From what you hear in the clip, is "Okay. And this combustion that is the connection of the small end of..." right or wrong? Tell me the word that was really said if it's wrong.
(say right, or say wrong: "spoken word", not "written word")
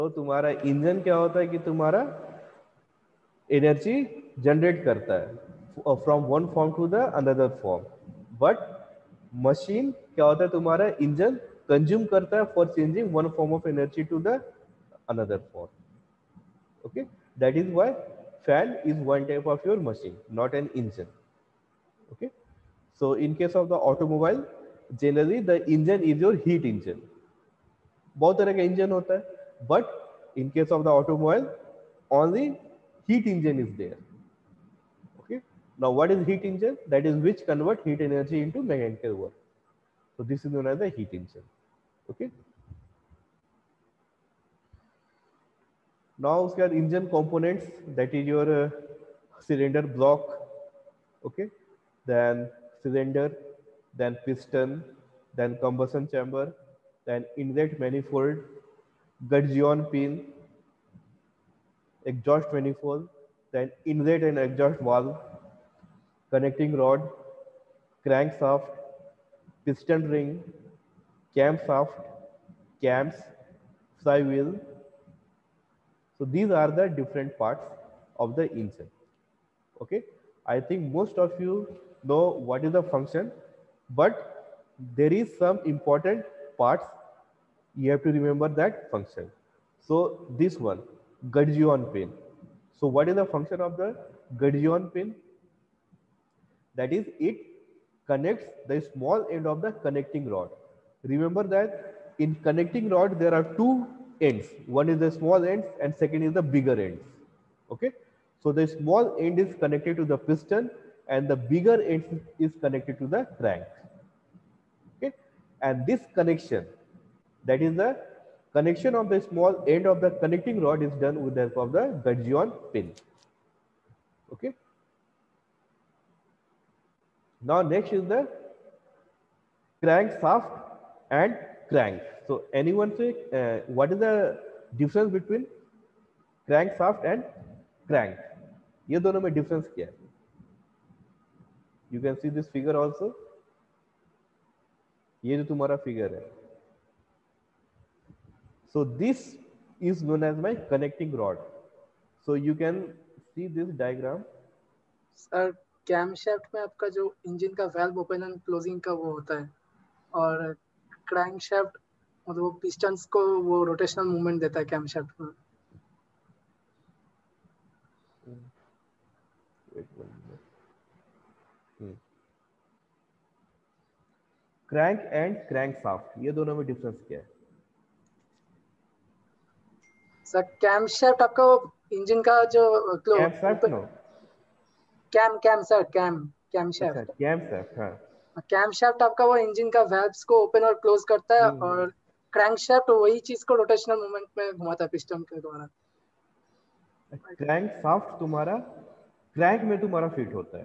wrong: "connection", not "combustion".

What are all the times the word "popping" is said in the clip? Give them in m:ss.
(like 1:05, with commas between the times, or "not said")
not said.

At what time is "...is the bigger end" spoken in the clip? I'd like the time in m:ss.
1:46.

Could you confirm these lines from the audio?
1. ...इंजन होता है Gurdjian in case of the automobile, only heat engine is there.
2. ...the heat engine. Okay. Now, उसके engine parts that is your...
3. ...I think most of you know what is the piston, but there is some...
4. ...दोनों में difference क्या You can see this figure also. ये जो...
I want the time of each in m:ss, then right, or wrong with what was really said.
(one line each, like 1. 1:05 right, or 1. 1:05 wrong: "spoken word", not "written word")
1. 0:28 wrong: "But", not "Gurdjian"
2. 0:40 wrong: "components", not "parts"
3. 1:20 wrong: "function", not "piston"
4. 2:18 right.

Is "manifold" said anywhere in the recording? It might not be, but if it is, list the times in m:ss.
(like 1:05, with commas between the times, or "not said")
0:57, 1:02.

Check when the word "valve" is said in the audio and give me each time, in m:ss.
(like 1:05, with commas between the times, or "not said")
1:04, 2:37.